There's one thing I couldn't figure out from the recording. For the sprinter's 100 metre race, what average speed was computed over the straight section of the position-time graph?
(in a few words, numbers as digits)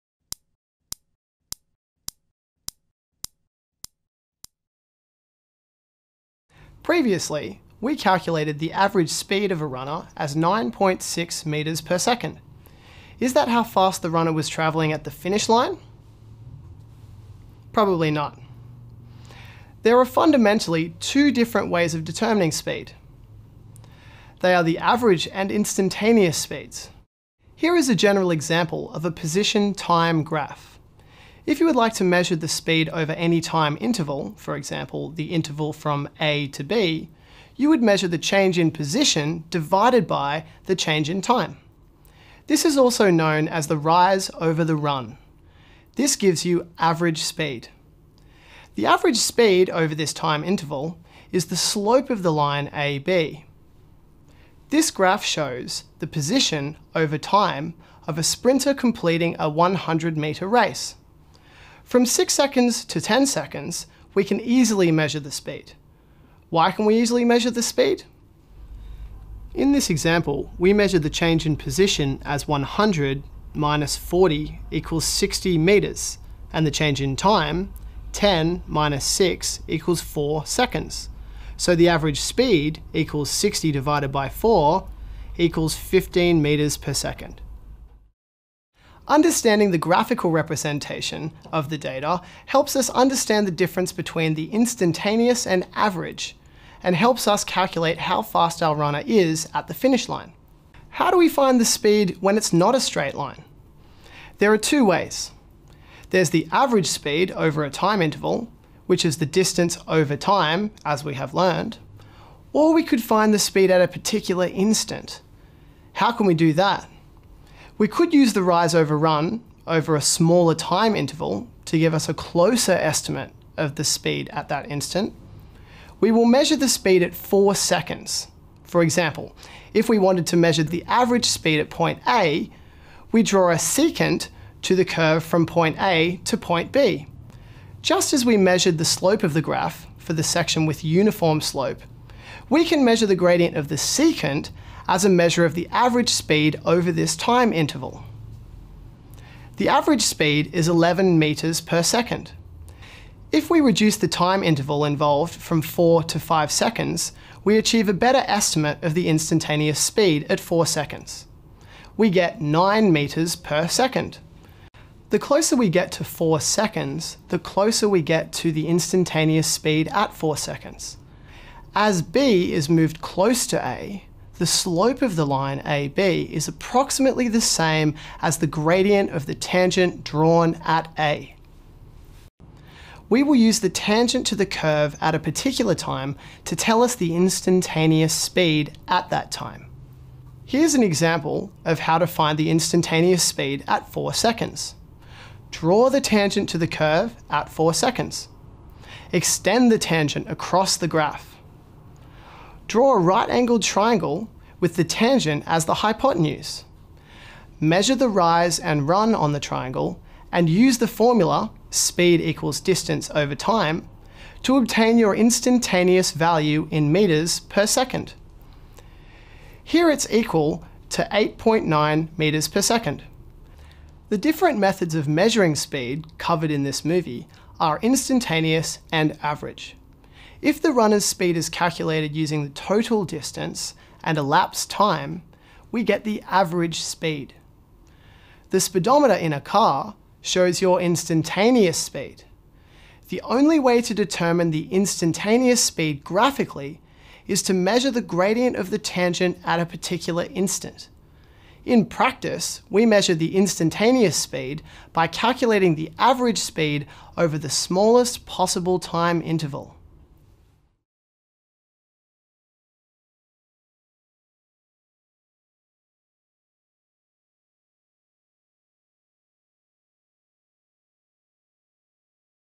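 15 meters per second.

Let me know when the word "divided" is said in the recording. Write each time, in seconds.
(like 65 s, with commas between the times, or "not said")
39 s, 83 s.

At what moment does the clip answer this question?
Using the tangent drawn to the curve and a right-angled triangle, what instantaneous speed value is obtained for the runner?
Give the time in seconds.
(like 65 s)
221 s.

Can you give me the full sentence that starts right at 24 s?
They are the average and instantaneous speeds.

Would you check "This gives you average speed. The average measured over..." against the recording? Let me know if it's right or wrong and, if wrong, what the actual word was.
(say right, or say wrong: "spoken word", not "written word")
wrong: "speed", not "measured".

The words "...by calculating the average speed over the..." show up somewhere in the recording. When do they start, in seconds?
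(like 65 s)
254 s.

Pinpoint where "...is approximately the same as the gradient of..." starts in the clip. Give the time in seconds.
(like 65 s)
176 s.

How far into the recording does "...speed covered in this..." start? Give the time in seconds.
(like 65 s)
225 s.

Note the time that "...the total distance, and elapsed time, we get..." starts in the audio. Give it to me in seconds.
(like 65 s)
232 s.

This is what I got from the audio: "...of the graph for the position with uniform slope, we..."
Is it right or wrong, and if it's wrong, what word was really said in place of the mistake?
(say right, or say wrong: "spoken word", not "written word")
wrong: "section", not "position".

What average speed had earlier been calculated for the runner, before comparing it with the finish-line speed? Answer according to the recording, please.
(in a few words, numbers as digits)
9.6 metres per second.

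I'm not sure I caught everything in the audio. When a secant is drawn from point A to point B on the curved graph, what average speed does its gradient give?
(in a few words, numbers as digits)
11 meters per second.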